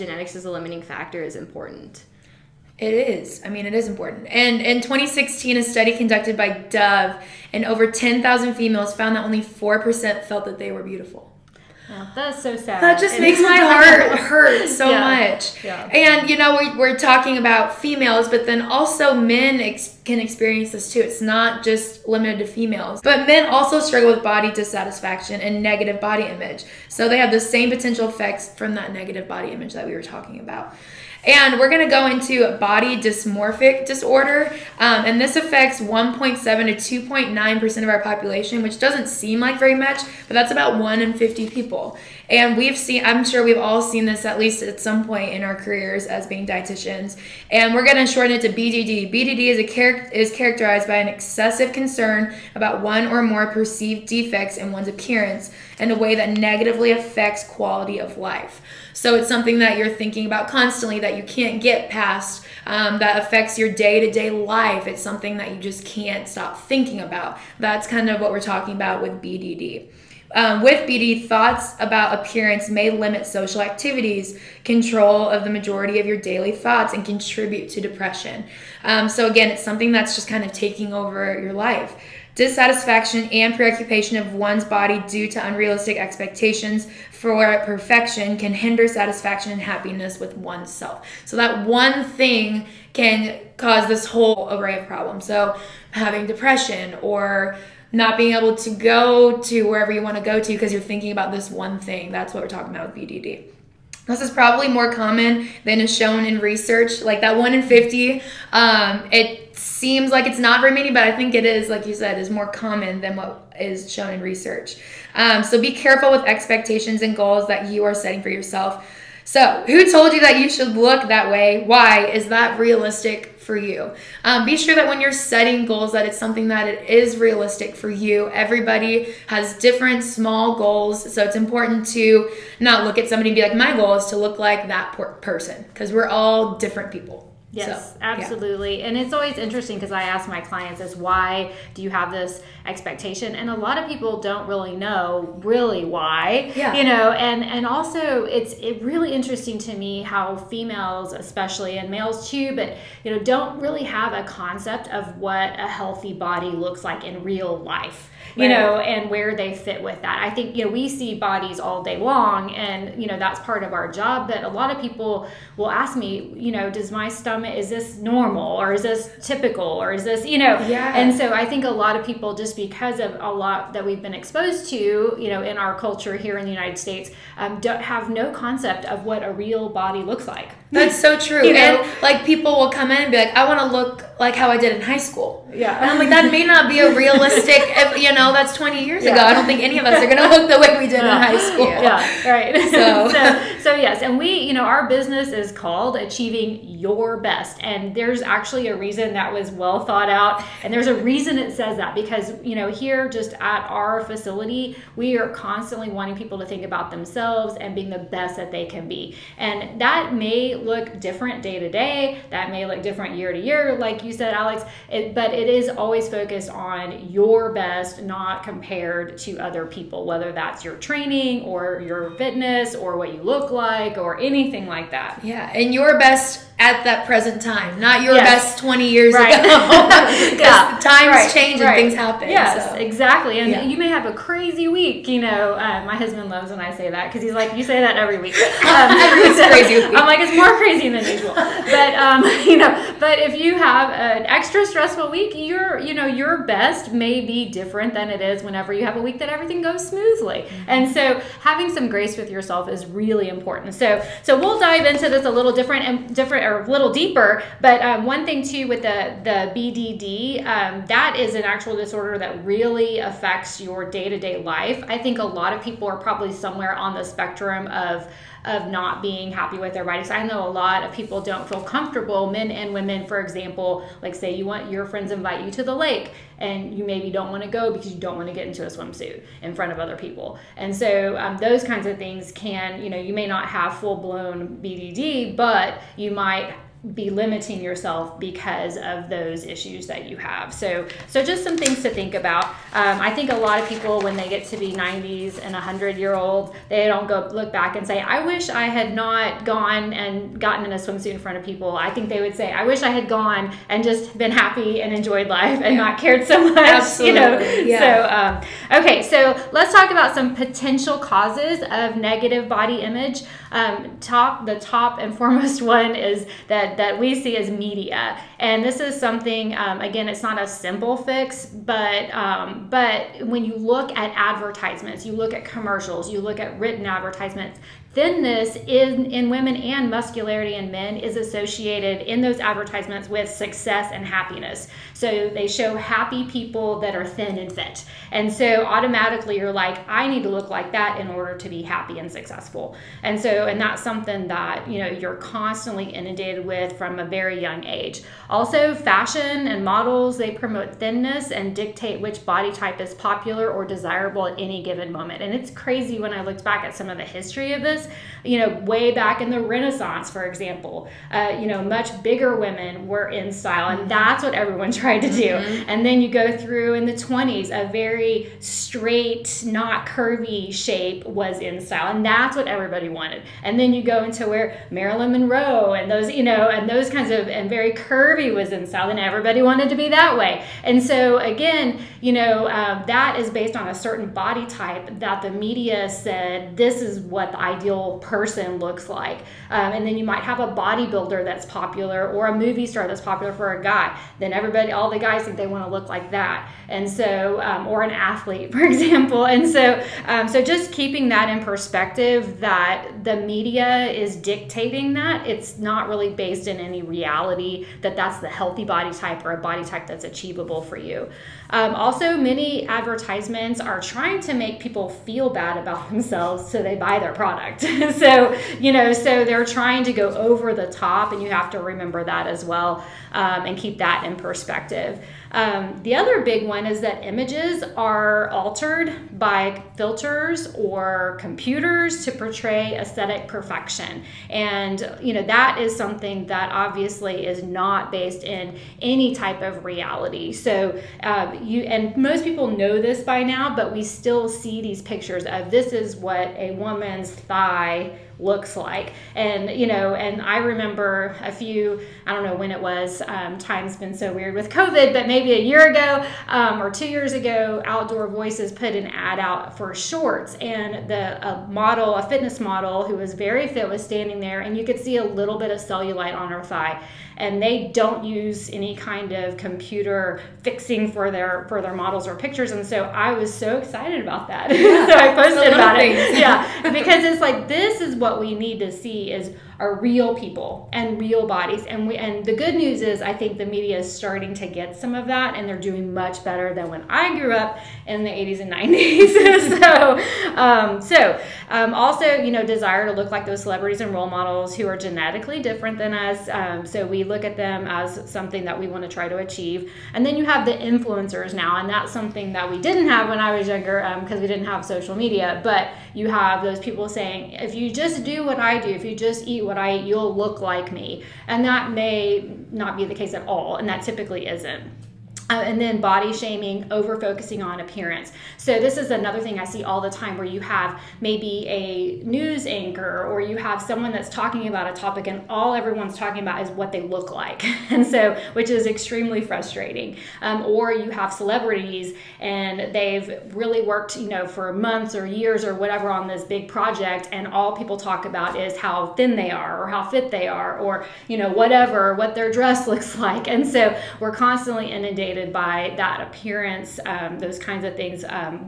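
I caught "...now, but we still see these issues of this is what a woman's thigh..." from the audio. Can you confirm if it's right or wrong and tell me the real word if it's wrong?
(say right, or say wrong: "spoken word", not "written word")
wrong: "pictures", not "issues".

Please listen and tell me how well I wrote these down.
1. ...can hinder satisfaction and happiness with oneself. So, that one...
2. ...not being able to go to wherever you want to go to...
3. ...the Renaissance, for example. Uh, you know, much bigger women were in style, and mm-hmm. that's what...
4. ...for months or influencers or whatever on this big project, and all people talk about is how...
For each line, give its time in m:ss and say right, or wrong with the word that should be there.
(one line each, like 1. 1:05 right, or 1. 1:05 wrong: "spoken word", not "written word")
1. 1:28 right
2. 1:37 right
3. 5:59 right
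4. 8:54 wrong: "years", not "influencers".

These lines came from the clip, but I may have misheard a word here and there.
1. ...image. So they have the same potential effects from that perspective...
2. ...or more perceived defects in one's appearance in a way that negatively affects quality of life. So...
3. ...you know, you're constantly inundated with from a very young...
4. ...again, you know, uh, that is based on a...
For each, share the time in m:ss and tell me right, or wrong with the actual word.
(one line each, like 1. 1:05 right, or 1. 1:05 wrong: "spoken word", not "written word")
1. 0:26 wrong: "negative", not "perspective"
2. 0:53 right
3. 5:44 right
4. 6:21 right.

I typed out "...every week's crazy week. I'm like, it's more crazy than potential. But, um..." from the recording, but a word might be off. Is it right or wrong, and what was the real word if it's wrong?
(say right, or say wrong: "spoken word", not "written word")
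wrong: "usual", not "potential".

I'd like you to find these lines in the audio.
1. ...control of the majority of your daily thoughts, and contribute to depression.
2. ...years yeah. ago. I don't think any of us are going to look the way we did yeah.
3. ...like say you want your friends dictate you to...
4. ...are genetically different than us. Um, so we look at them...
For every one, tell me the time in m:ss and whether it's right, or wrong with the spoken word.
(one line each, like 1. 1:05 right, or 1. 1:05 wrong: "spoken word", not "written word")
1. 1:14 right
2. 3:08 right
3. 4:34 wrong: "invite", not "dictate"
4. 8:14 right.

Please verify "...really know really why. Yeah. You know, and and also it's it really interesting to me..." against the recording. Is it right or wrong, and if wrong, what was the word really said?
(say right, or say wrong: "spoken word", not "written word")
right.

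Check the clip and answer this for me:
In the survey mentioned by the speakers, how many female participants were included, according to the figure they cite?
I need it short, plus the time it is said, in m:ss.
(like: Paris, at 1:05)
over 10,000, at 0:07.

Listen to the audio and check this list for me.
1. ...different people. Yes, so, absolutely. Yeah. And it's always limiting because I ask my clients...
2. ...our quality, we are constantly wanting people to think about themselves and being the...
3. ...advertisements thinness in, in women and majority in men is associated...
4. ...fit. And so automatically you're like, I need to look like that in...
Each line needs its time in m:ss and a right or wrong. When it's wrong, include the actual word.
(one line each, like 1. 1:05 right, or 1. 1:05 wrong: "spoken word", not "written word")
1. 2:16 wrong: "interesting", not "limiting"
2. 3:23 wrong: "facility", not "quality"
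3. 5:26 wrong: "muscularity", not "majority"
4. 5:37 right.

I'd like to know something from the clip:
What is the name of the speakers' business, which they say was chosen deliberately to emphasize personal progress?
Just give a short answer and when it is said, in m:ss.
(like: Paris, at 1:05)
Achieving Your Best, at 3:15.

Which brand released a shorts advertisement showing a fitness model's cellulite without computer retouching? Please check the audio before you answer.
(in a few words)
Outdoor Voices.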